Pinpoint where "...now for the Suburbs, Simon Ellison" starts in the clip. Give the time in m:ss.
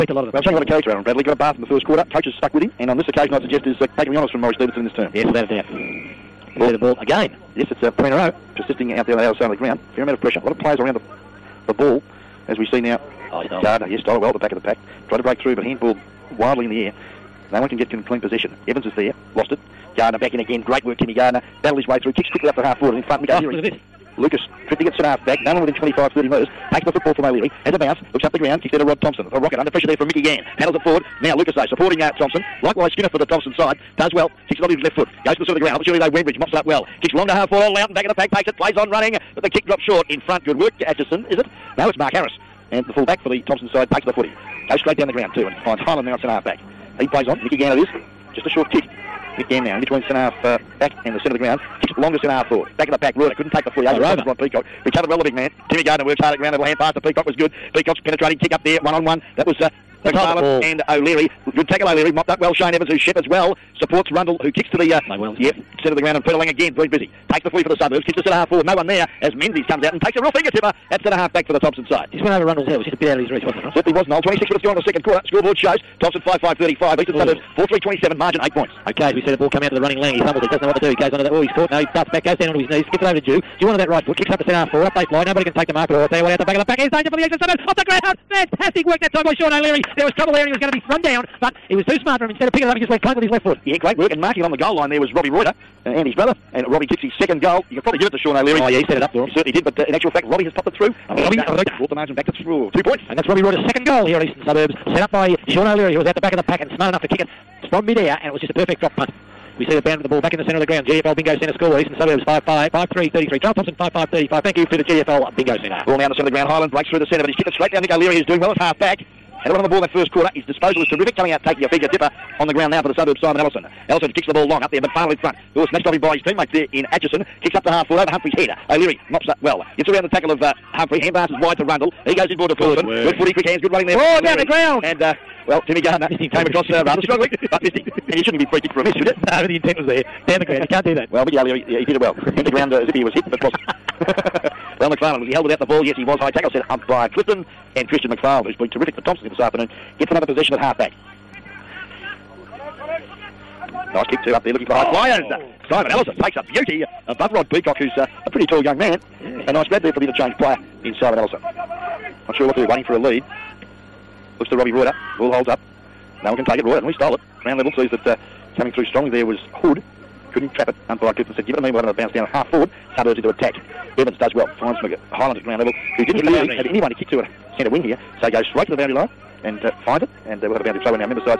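2:02.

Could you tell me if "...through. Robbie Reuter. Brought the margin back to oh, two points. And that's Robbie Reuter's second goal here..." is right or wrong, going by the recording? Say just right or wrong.
right.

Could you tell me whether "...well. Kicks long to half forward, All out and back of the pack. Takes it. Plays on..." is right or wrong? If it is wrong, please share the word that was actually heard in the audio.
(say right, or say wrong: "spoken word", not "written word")
right.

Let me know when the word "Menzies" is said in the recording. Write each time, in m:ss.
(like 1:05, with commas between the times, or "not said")
1:09.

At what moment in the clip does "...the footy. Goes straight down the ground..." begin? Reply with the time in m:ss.
0:44.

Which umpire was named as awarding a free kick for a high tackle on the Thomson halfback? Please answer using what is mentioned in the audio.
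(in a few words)
Clifton.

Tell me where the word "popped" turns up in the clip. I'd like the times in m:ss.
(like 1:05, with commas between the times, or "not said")
1:40.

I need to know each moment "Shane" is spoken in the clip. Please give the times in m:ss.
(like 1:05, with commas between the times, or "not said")
1:02.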